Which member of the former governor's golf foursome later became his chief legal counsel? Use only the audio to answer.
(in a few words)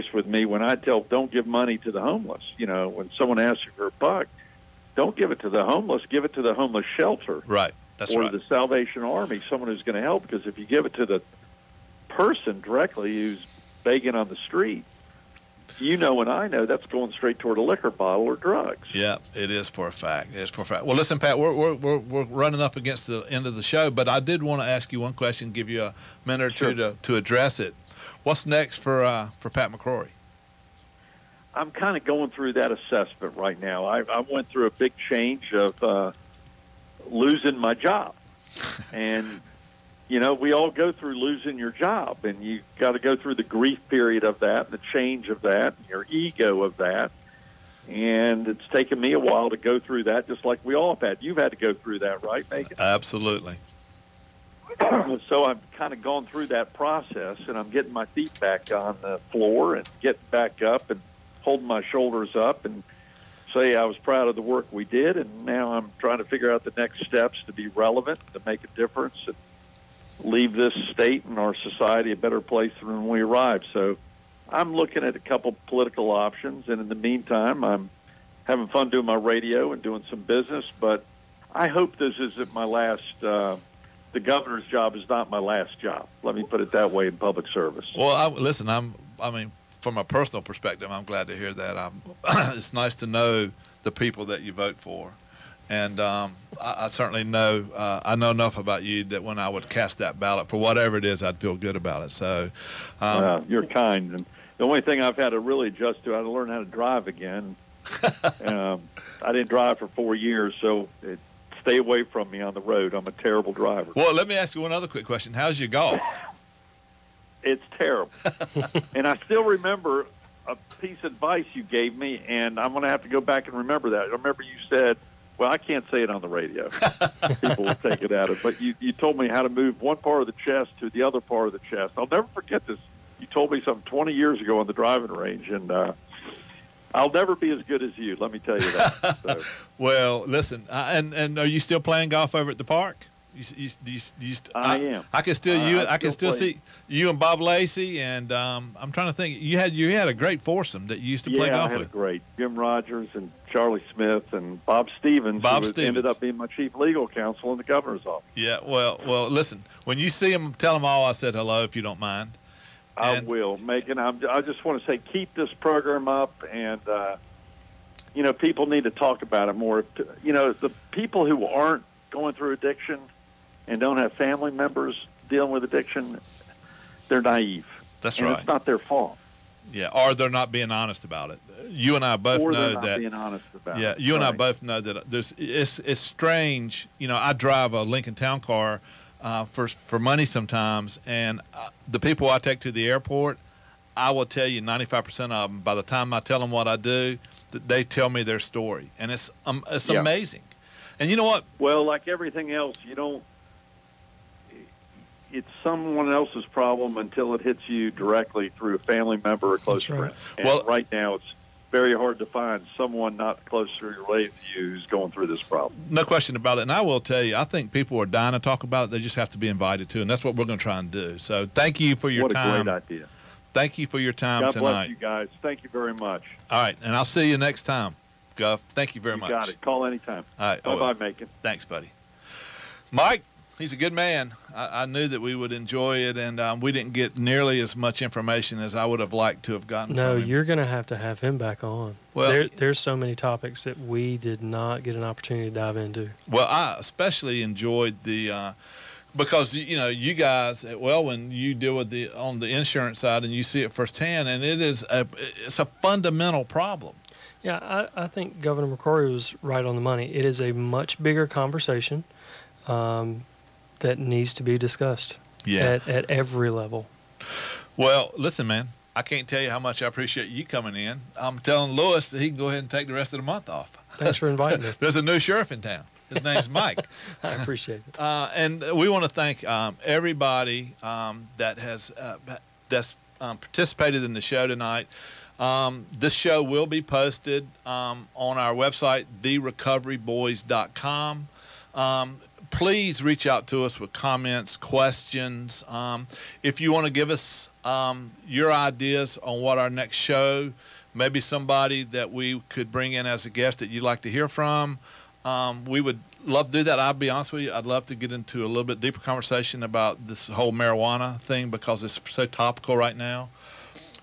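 Bob Stevens.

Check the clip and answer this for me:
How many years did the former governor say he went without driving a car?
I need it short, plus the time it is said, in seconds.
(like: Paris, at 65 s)
4, at 109 s.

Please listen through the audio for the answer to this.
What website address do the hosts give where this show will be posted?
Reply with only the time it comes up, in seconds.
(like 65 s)
289 s.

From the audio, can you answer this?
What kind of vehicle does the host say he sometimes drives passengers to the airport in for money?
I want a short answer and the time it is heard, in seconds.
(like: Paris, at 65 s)
Lincoln Town Car, at 187 s.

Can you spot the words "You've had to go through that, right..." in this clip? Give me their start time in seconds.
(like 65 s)
51 s.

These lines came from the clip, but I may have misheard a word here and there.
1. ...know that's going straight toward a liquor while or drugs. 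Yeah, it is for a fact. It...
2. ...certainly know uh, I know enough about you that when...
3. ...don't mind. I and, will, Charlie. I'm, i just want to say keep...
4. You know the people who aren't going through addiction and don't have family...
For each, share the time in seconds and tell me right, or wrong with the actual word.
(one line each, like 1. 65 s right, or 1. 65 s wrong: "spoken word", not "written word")
1. 16 s wrong: "bottle", not "while"
2. 96 s right
3. 161 s wrong: "Macon", not "Charlie"
4. 170 s right.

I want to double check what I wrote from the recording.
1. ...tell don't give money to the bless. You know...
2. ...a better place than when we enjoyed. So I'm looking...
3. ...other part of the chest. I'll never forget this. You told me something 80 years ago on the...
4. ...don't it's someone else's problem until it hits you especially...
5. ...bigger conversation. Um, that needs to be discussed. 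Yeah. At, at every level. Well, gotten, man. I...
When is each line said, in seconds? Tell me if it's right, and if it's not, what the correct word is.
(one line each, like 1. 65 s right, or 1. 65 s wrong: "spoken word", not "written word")
1. 0 s wrong: "homeless", not "bless"
2. 72 s wrong: "arrived", not "enjoyed"
3. 131 s wrong: "20", not "80"
4. 202 s wrong: "directly", not "especially"
5. 260 s wrong: "listen", not "gotten".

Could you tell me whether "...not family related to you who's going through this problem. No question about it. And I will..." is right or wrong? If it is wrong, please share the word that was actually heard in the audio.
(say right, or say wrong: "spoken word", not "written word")
wrong: "closely", not "family".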